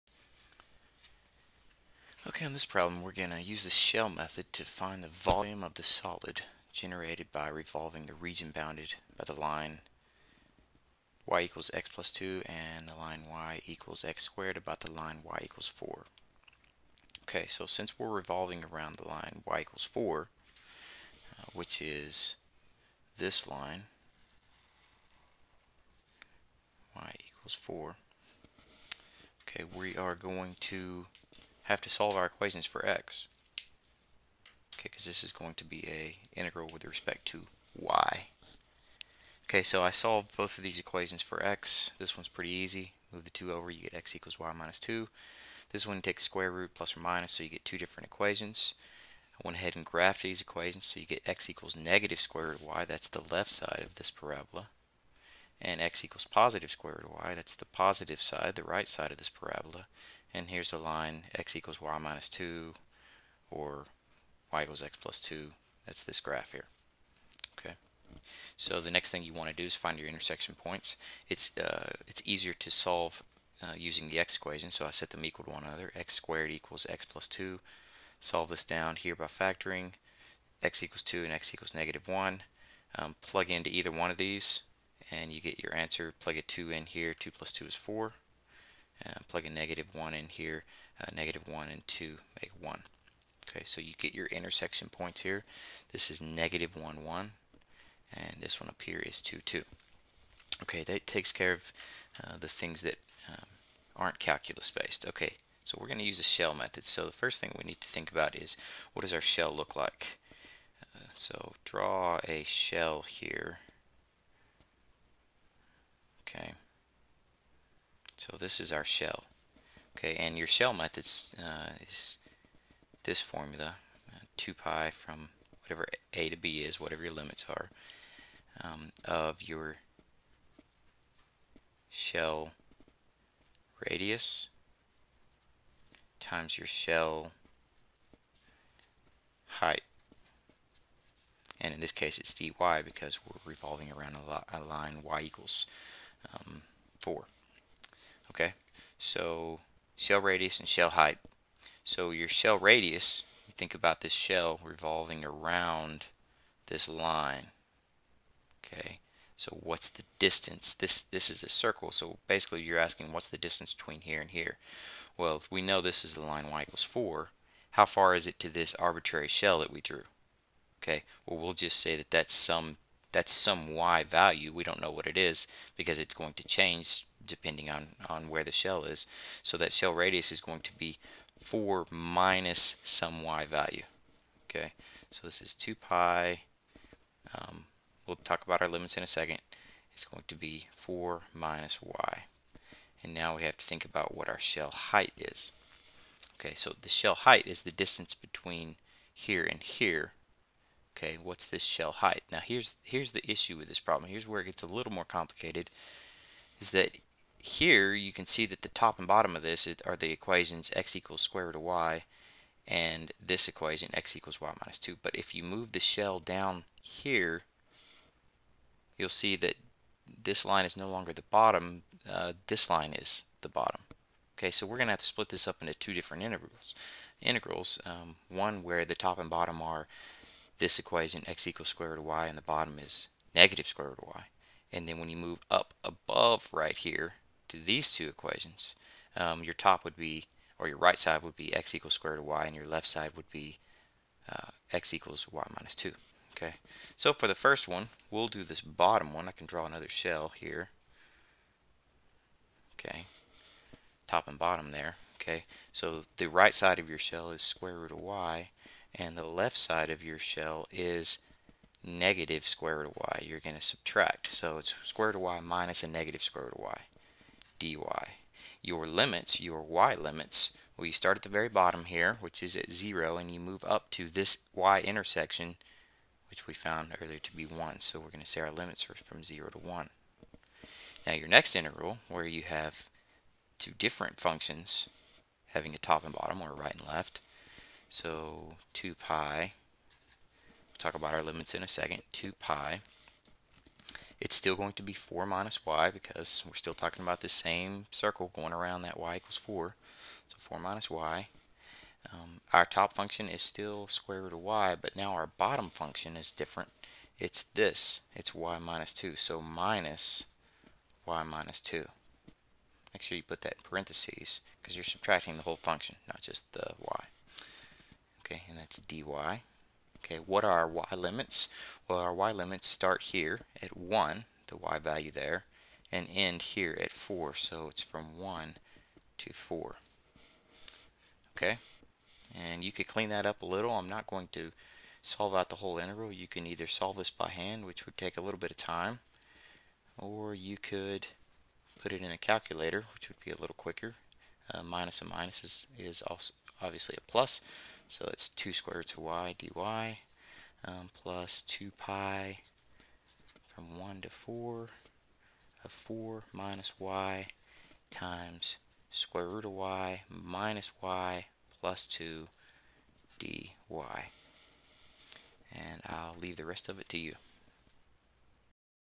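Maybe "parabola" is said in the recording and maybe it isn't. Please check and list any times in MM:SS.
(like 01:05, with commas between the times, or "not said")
00:54, 00:59.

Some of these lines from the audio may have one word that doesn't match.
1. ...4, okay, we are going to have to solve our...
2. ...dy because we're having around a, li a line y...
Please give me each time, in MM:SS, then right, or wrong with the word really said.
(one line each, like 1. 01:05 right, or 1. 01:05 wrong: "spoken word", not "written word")
1. 00:27 right
2. 02:22 wrong: "revolving", not "having".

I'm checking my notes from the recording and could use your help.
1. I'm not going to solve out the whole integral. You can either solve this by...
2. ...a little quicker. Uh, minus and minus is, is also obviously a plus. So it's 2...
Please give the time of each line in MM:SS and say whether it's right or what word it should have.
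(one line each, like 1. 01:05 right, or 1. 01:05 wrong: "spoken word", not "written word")
1. 05:33 right
2. 05:43 right.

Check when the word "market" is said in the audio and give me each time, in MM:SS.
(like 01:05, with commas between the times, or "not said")
not said.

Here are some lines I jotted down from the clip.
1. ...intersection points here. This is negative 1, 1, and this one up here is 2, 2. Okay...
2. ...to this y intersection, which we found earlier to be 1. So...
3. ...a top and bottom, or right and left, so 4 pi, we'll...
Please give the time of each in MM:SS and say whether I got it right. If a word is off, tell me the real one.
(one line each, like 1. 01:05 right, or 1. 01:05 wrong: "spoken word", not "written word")
1. 01:34 right
2. 04:33 right
3. 04:45 wrong: "2", not "4".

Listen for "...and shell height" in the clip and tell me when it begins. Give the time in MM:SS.
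02:30.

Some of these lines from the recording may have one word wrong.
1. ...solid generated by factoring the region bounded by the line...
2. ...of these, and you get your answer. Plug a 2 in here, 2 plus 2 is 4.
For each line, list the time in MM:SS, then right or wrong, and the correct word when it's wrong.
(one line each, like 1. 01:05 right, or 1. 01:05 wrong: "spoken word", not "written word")
1. 00:05 wrong: "revolving", not "factoring"
2. 01:24 right.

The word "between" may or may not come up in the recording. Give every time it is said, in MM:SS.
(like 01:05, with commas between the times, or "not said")
02:43, 03:18.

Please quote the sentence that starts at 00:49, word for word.
I went ahead and graphed these equations, so you get x equals negative square root of y.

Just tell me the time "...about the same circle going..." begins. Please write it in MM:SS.
04:57.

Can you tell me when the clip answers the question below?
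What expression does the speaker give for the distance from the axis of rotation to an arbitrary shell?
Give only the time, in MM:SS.
03:01.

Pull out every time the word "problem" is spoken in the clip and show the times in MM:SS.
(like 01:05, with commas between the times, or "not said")
00:02, 03:23.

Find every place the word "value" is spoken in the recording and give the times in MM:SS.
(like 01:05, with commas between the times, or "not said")
02:54, 03:03, 05:24.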